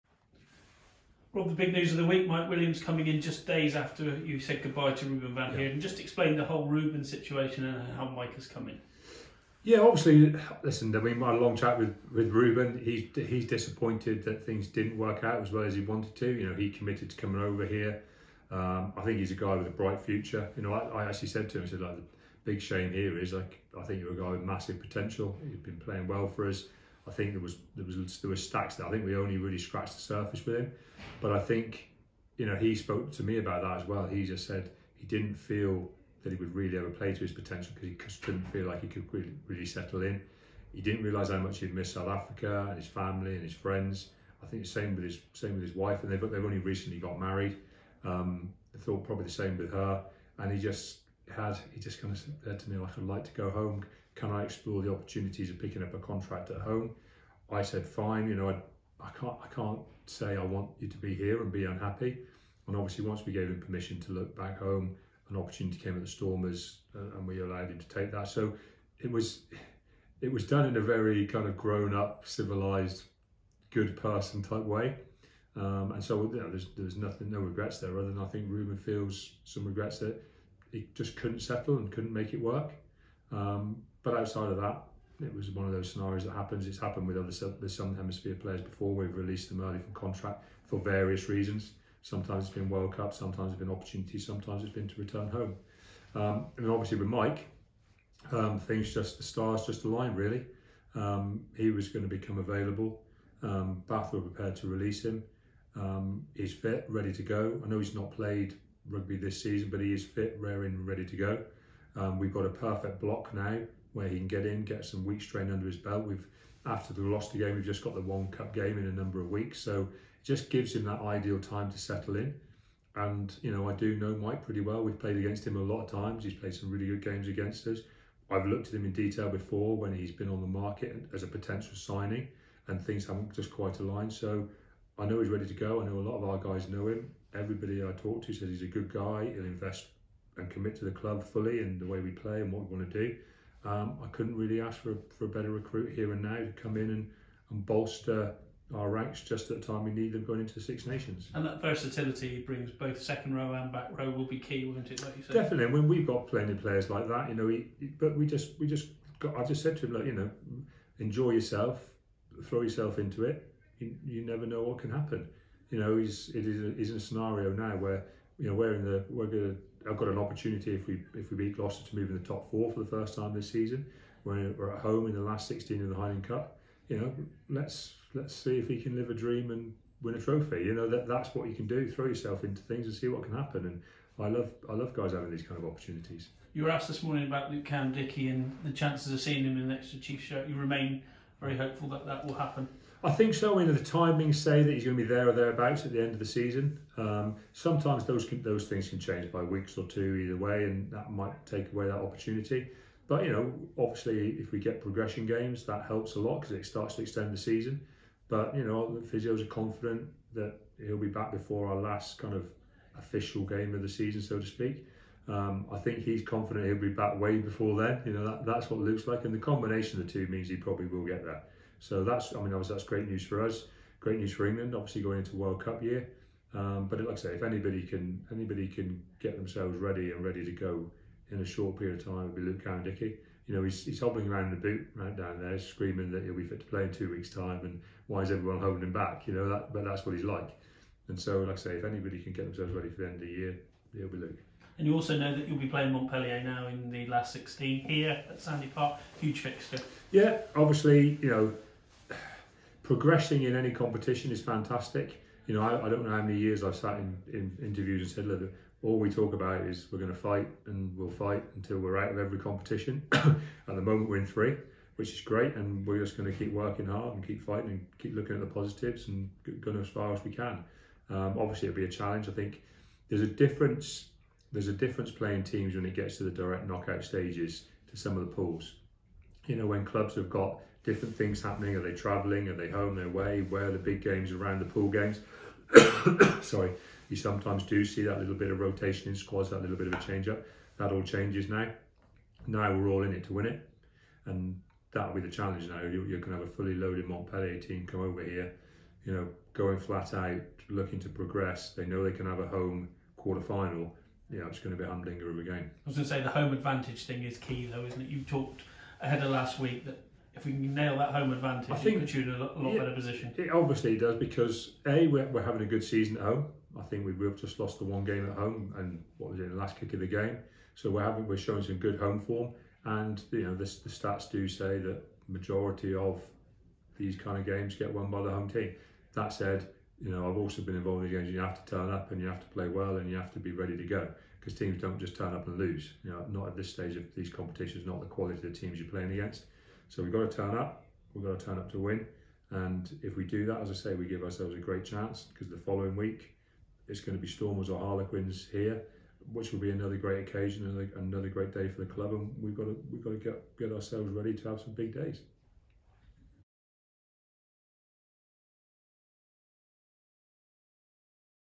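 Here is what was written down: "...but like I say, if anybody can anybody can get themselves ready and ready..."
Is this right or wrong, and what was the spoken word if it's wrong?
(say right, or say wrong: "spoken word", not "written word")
right.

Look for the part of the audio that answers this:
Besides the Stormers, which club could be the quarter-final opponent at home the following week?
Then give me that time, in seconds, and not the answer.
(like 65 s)
347 s.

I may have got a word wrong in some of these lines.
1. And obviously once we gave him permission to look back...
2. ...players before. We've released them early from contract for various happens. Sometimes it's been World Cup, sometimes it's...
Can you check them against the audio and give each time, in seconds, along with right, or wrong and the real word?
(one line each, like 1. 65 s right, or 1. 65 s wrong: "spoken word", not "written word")
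1. 62 s right
2. 88 s wrong: "reasons", not "happens".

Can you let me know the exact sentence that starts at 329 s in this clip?
That said, you know, I've also been involved in games.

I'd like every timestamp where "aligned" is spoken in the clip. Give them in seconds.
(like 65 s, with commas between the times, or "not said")
99 s, 133 s.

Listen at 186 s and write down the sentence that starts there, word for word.
You were asked this morning about Luke Cowan-Dickie and the chances of seeing him in next to chief shirt.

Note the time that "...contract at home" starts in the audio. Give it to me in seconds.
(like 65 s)
55 s.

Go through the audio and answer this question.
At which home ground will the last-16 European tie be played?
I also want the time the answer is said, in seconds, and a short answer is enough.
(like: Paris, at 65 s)
Sandy Park, at 248 s.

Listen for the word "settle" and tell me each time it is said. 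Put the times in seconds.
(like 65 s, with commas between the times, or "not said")
39 s, 81 s, 121 s.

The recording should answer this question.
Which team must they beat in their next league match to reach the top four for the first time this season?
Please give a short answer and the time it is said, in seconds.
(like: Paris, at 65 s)
Gloucester, at 171 s.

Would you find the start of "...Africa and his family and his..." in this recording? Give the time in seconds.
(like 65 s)
42 s.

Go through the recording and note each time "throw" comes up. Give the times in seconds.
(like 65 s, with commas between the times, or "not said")
162 s, 181 s.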